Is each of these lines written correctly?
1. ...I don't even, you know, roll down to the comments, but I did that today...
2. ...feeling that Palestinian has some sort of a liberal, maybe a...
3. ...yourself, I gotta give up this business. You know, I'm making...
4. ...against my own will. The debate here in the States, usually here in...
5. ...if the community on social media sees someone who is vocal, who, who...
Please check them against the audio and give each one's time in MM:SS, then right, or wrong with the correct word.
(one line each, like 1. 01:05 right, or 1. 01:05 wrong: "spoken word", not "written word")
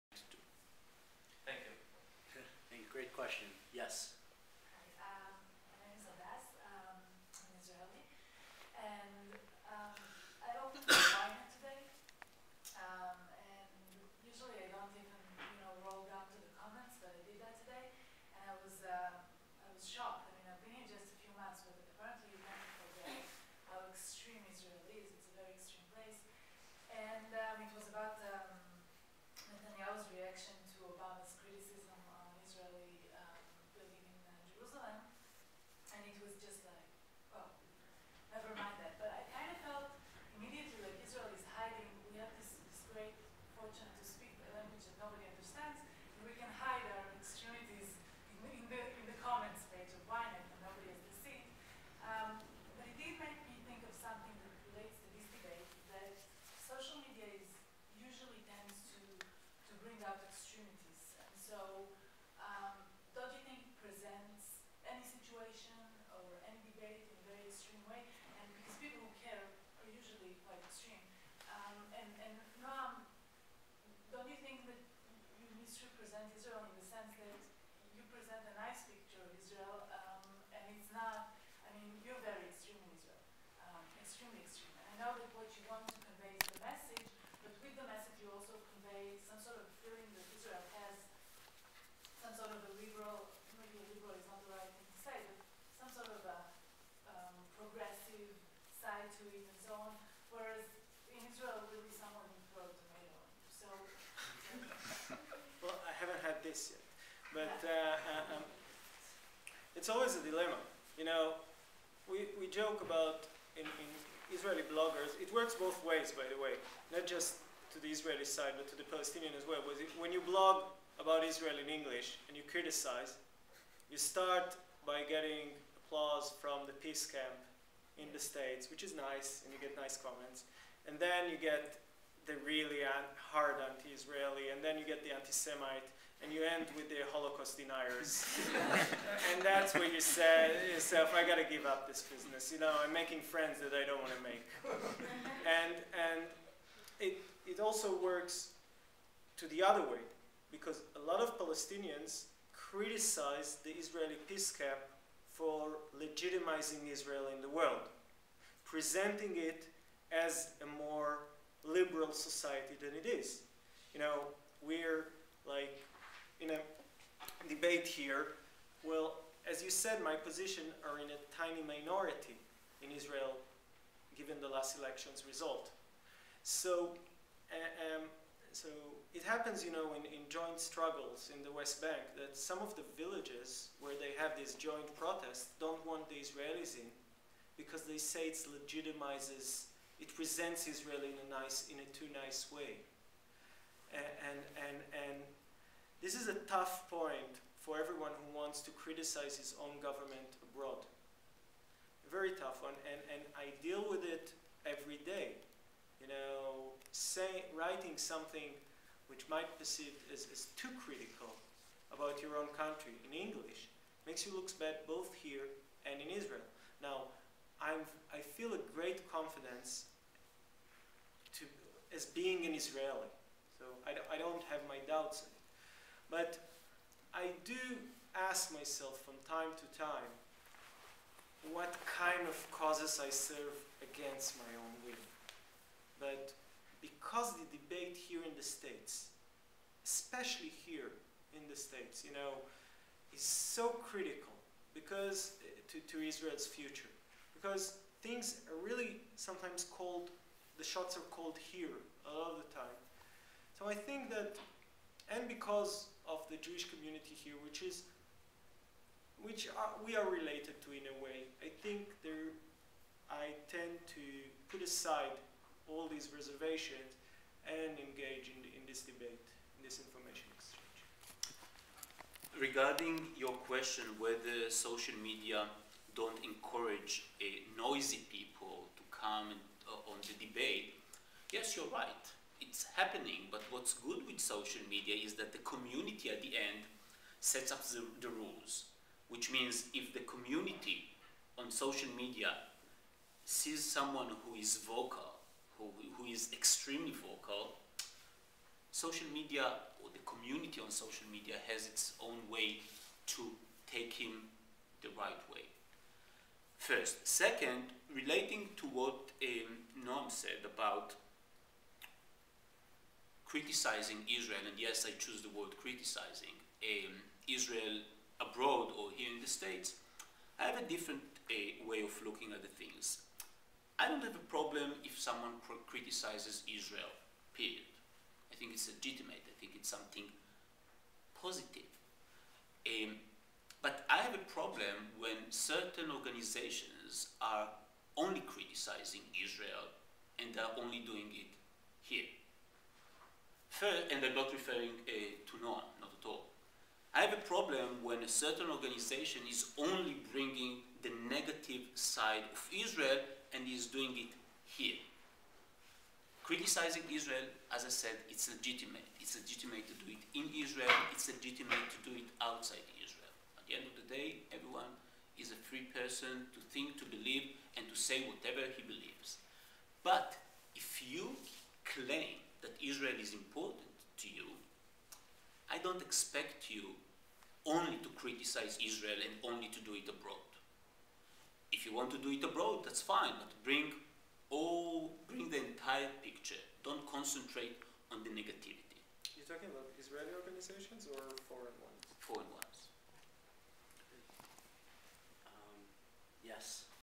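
1. 00:14 right
2. 01:29 wrong: "Israel", not "Palestinian"
3. 02:20 right
4. 03:53 wrong: "especially", not "usually"
5. 04:49 right.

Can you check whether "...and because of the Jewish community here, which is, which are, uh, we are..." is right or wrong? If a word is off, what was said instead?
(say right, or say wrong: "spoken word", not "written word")
right.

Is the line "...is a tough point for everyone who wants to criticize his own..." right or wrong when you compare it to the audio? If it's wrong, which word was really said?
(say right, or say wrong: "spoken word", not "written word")
right.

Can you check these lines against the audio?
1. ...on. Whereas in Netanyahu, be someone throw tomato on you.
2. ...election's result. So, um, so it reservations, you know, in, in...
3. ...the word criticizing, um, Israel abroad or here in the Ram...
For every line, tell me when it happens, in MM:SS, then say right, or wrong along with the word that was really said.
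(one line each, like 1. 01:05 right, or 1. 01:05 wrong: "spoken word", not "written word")
1. 01:39 wrong: "Israel", not "Netanyahu"
2. 02:54 wrong: "happens", not "reservations"
3. 05:15 wrong: "States", not "Ram".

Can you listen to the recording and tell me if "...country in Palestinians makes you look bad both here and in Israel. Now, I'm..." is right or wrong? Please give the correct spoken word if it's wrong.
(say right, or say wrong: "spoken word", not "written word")
wrong: "English", not "Palestinians".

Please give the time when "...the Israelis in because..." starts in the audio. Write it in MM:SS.
03:06.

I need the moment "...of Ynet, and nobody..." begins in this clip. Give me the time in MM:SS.
00:49.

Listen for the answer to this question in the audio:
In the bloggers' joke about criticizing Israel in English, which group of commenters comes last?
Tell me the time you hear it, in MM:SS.
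02:17.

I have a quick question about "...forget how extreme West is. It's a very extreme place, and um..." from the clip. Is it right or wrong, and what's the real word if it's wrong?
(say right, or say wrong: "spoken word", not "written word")
wrong: "Israel", not "West".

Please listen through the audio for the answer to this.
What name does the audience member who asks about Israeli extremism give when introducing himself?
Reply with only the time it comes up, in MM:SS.
00:06.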